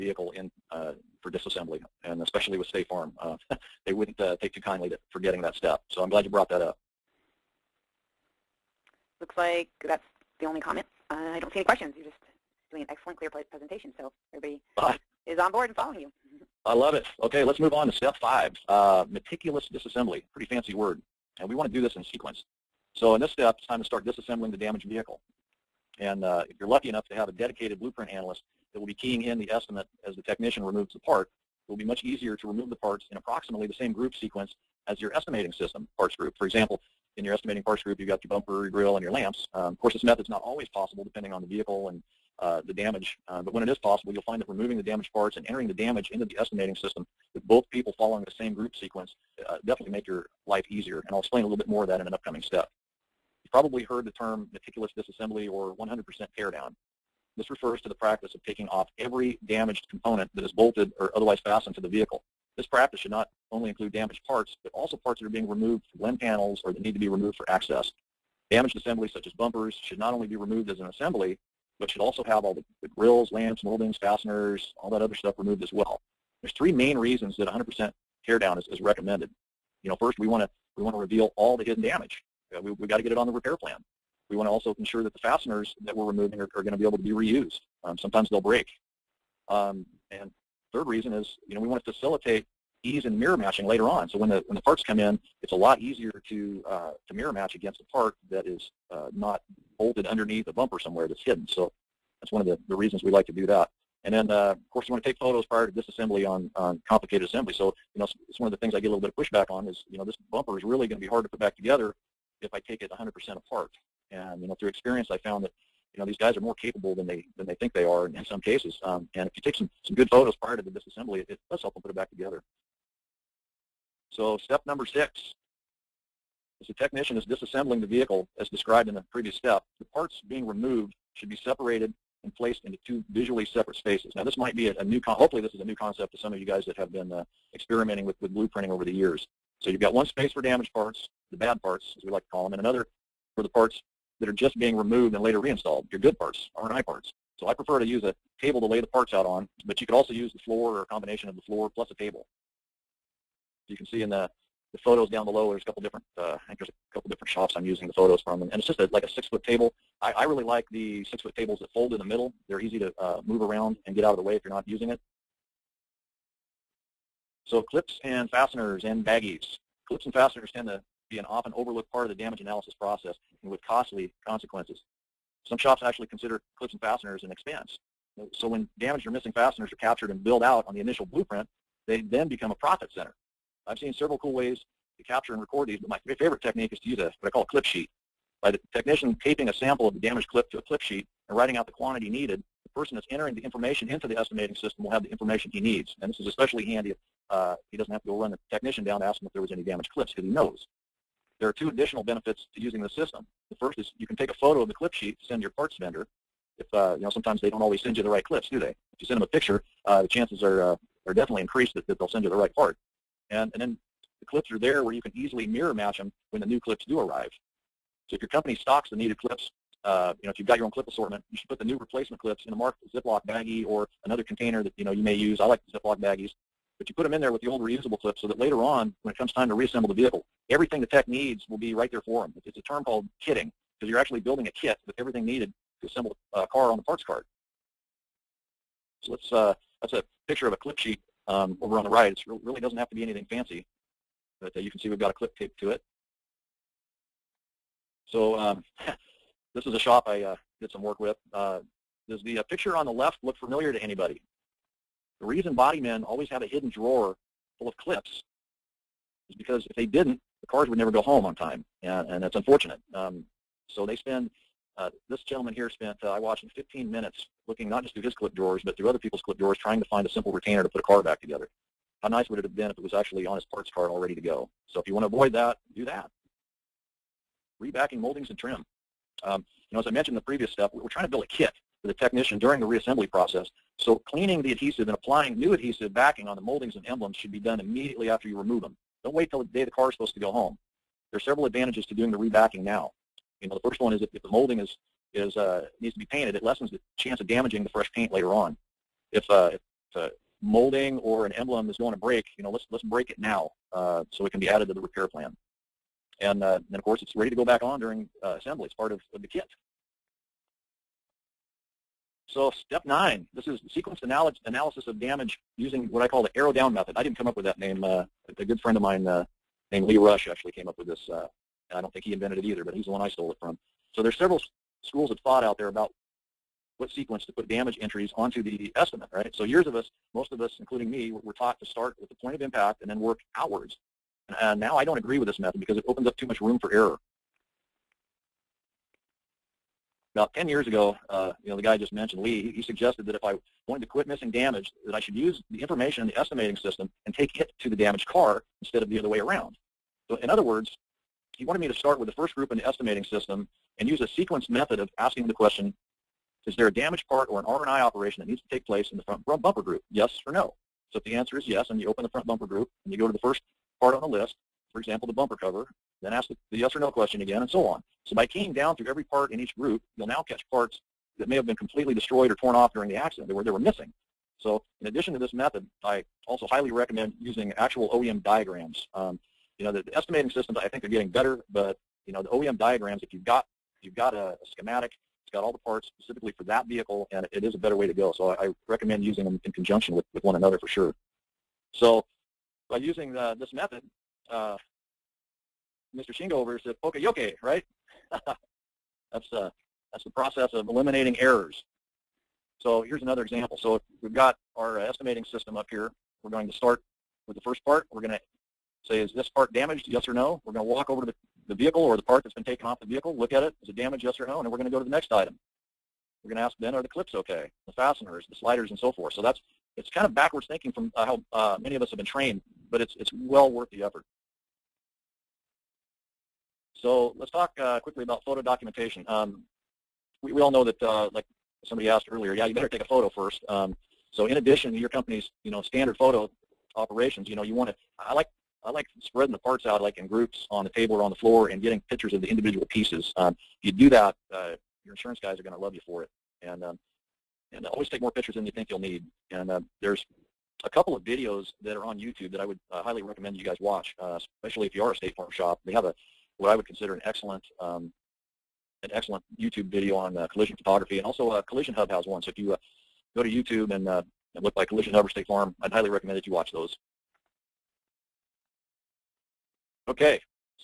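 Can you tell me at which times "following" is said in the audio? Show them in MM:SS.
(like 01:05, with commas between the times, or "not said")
00:15, 00:47.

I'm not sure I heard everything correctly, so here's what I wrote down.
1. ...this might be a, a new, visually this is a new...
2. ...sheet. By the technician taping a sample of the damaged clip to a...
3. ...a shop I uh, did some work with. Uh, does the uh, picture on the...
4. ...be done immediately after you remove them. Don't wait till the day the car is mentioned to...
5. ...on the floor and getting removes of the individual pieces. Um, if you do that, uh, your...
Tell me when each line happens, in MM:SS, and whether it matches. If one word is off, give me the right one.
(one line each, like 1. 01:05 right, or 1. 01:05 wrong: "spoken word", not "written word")
1. 02:14 wrong: "hopefully", not "visually"
2. 03:07 right
3. 04:09 right
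4. 04:47 wrong: "supposed", not "mentioned"
5. 07:21 wrong: "pictures", not "removes".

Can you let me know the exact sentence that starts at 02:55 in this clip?
Some shops actually consider clips and fasteners an expense.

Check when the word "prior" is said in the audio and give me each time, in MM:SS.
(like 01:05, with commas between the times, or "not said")
01:45, 02:00.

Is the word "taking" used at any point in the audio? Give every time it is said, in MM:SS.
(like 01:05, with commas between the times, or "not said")
00:58.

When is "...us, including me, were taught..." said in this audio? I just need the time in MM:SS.
05:30.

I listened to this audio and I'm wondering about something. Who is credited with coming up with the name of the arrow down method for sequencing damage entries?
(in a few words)
Lee Rush.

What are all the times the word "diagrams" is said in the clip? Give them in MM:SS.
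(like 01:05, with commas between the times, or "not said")
06:18, 06:22.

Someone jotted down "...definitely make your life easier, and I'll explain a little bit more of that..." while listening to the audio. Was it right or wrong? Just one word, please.
right.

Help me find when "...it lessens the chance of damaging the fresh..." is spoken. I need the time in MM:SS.
04:56.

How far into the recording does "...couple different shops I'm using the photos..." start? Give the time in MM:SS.
02:36.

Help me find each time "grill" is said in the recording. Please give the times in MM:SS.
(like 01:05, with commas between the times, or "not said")
00:38, 01:12.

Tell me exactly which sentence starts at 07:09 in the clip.
Um, we, we all know that, uh, like somebody asked earlier, yeah, you better take a photo first.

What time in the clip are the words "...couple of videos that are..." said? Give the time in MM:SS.
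07:30.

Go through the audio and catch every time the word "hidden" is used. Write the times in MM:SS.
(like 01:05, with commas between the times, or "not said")
01:21, 01:41, 04:16.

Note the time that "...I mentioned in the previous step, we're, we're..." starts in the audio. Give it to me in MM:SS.
04:39.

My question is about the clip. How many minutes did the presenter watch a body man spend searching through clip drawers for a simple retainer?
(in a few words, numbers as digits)
15.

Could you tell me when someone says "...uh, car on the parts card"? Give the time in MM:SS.
03:56.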